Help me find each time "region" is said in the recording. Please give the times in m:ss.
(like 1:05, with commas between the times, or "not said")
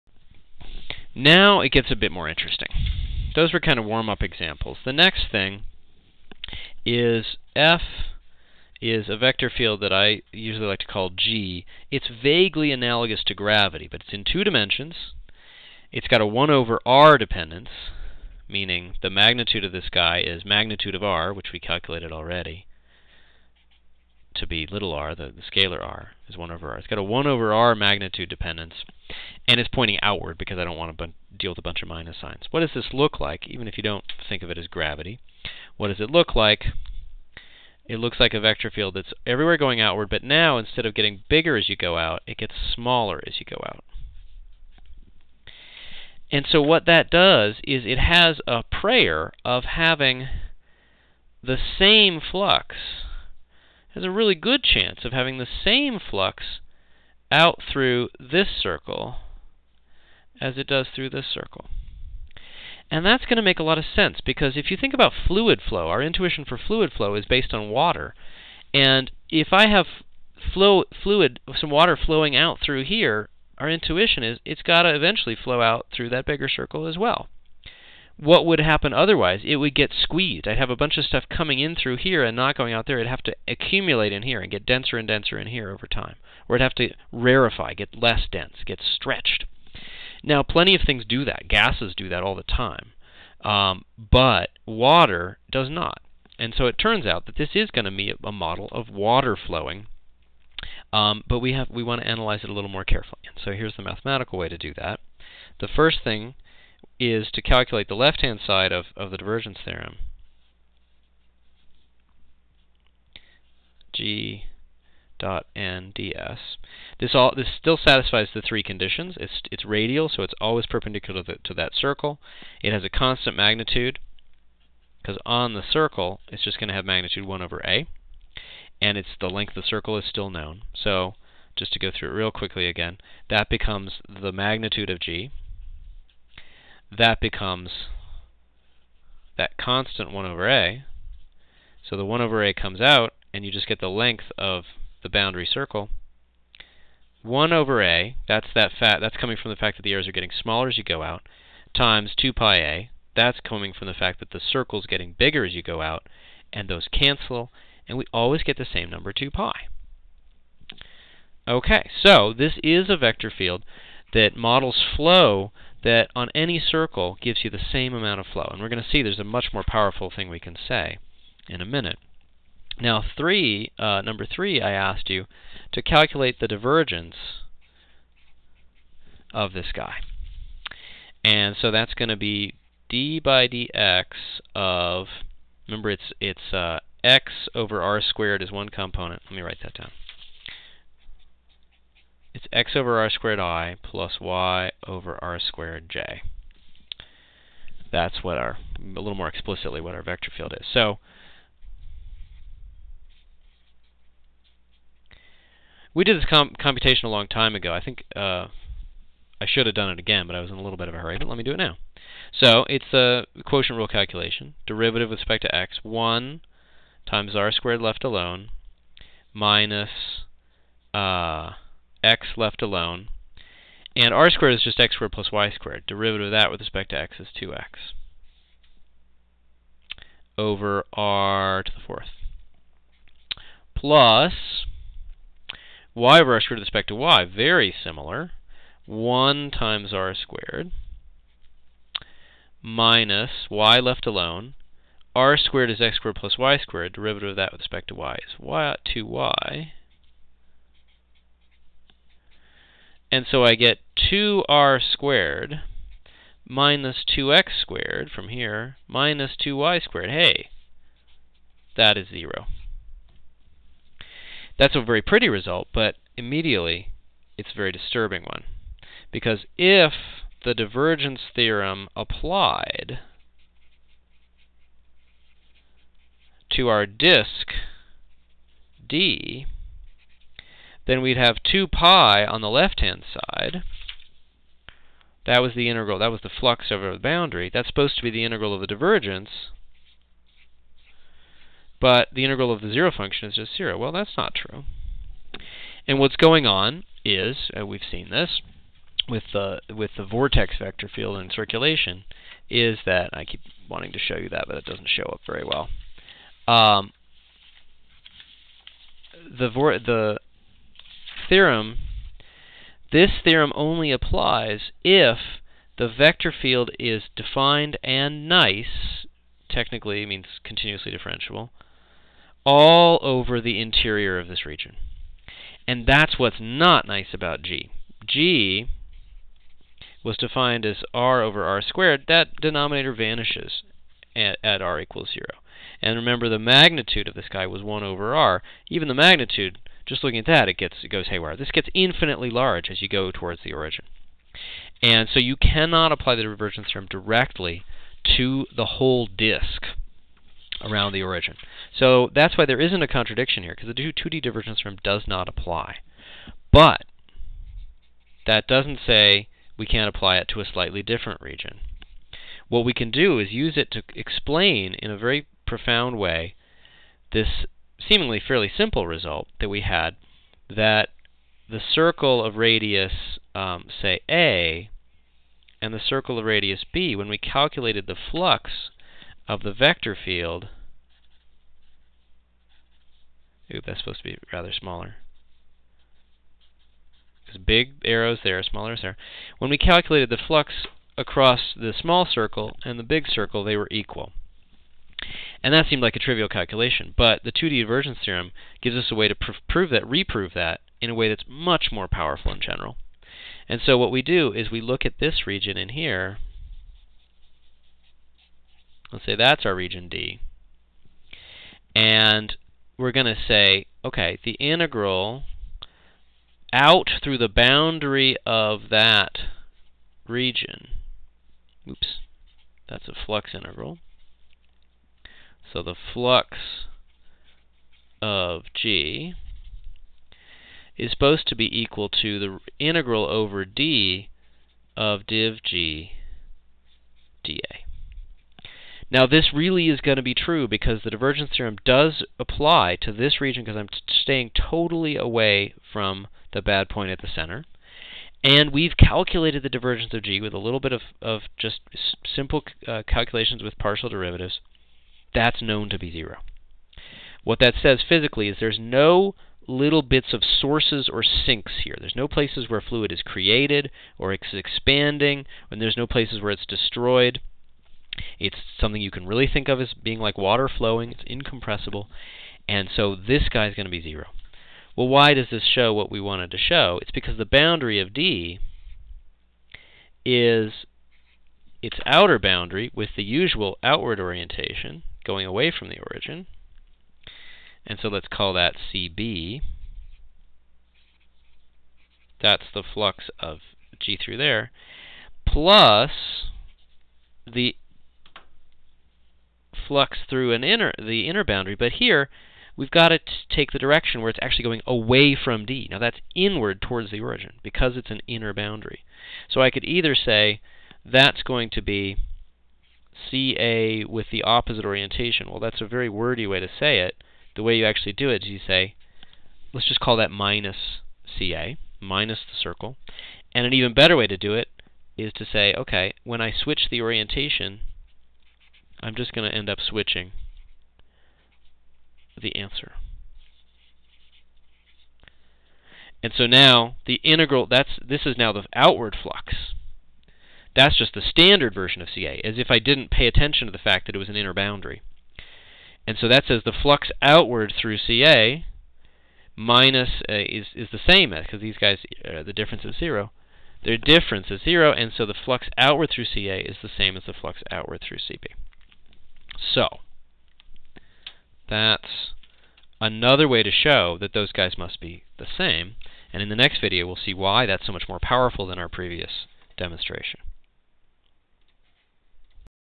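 5:24, 6:01, 6:45, 6:49, 7:00, 7:23.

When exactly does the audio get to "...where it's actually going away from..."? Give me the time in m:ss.
8:24.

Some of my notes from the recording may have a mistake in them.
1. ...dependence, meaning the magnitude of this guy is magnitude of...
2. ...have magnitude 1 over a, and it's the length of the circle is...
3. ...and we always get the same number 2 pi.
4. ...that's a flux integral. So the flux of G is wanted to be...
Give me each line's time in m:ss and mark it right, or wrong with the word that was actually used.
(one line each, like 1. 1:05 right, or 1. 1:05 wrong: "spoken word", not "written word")
1. 0:17 right
2. 2:06 right
3. 2:37 right
4. 7:02 wrong: "supposed", not "wanted".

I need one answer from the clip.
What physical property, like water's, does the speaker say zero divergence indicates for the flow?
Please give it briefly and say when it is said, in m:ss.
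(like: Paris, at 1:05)
incompressible, at 7:51.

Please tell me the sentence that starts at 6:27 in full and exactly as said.
Because big arrows there, smaller arrows there.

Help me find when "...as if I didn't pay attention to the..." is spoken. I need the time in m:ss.
9:02.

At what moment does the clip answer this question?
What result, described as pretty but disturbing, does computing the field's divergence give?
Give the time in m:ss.
4:21.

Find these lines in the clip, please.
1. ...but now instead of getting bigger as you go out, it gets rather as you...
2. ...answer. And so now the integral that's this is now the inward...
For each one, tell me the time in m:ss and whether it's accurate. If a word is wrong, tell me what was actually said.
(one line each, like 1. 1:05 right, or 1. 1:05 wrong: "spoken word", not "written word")
1. 0:40 wrong: "smaller", not "rather"
2. 8:52 wrong: "outward", not "inward".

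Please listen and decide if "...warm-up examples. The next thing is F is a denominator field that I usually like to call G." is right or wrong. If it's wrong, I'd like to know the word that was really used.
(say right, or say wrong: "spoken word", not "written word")
wrong: "vector", not "denominator".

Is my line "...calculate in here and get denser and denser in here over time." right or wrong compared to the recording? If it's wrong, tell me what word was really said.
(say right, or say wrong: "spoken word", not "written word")
wrong: "accumulate", not "calculate".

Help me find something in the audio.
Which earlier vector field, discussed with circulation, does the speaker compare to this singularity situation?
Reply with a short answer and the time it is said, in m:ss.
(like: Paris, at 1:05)
vortex vector field, at 5:00.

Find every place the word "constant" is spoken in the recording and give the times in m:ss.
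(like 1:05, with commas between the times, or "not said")
2:02, 2:19.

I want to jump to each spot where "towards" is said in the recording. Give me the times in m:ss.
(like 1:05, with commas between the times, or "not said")
5:43, 8:26.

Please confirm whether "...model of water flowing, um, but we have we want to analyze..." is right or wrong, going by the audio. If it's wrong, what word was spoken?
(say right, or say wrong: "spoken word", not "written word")
right.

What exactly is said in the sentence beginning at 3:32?
So it's the quotient rule calculation.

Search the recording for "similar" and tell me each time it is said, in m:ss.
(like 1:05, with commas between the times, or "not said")
3:57.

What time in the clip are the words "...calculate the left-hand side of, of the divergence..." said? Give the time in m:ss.
1:47.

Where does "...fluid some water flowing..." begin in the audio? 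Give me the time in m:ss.
1:11.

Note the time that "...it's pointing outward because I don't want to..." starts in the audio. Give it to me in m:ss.
0:29.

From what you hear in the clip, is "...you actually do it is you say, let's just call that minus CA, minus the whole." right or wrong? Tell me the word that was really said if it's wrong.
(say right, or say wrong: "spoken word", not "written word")
wrong: "circle", not "whole".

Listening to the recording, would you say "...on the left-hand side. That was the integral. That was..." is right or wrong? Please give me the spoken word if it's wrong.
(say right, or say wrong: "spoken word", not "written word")
right.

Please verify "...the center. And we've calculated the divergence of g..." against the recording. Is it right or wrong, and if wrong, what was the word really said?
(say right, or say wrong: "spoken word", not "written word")
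right.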